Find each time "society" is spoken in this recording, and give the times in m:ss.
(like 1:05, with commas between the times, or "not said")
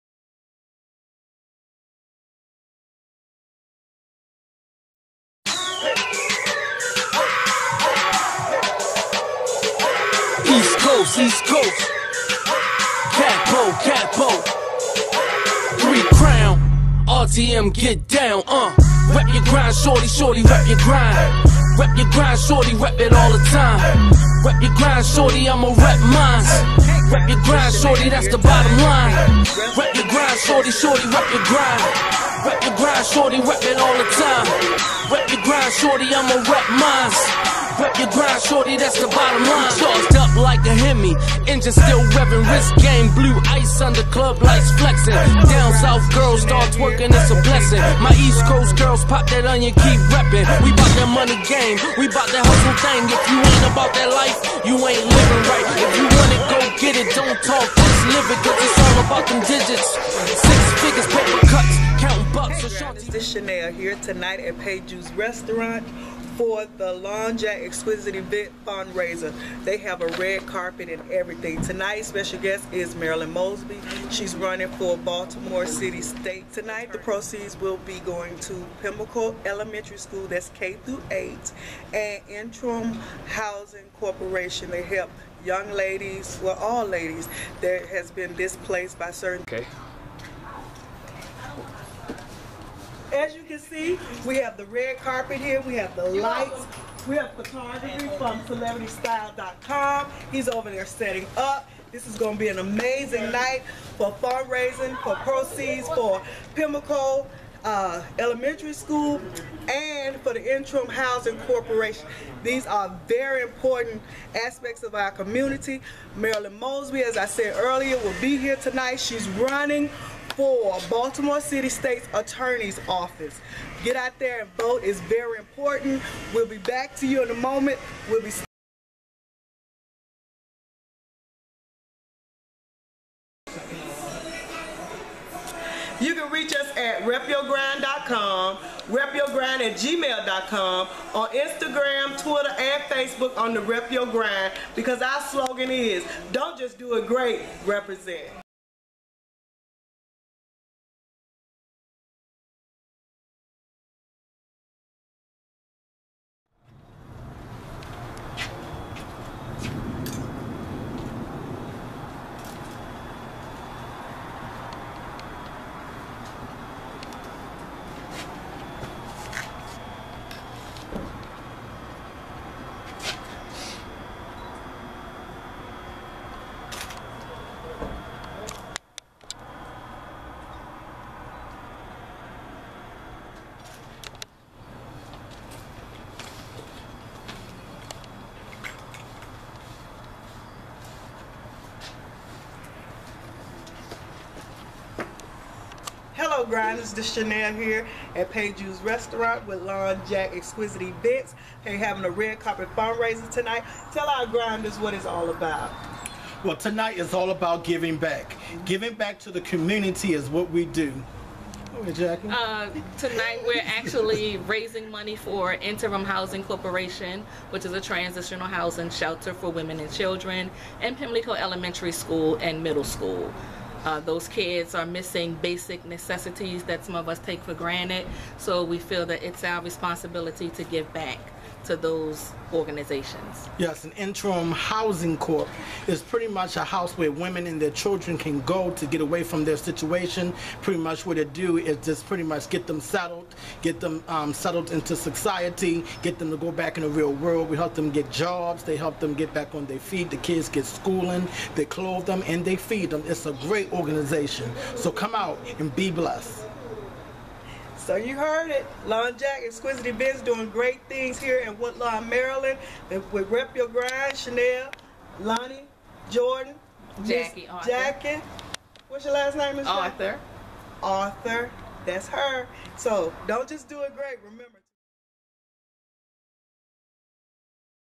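4:04.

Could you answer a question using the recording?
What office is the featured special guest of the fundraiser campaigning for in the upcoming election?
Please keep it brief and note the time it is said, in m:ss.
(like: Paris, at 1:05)
Baltimore City State's Attorney, at 2:00.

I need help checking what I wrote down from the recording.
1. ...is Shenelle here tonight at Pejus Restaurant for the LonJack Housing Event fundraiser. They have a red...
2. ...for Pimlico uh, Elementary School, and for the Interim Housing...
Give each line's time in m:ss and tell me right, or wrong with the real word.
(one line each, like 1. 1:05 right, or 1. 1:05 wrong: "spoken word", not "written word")
1. 1:03 wrong: "Exquisite", not "Housing"
2. 1:45 right.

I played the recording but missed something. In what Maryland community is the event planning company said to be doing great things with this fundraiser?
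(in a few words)
Woodlawn.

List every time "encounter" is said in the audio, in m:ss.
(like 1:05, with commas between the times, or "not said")
not said.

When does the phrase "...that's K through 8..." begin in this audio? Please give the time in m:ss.
1:20.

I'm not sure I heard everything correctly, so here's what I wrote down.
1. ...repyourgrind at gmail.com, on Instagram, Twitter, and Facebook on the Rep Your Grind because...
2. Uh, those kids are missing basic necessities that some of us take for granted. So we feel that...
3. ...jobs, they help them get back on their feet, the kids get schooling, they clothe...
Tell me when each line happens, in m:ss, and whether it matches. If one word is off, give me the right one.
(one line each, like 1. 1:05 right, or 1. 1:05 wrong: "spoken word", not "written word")
1. 2:18 right
2. 3:43 right
3. 4:08 right.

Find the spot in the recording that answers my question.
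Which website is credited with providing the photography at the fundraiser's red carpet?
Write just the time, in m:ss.
1:38.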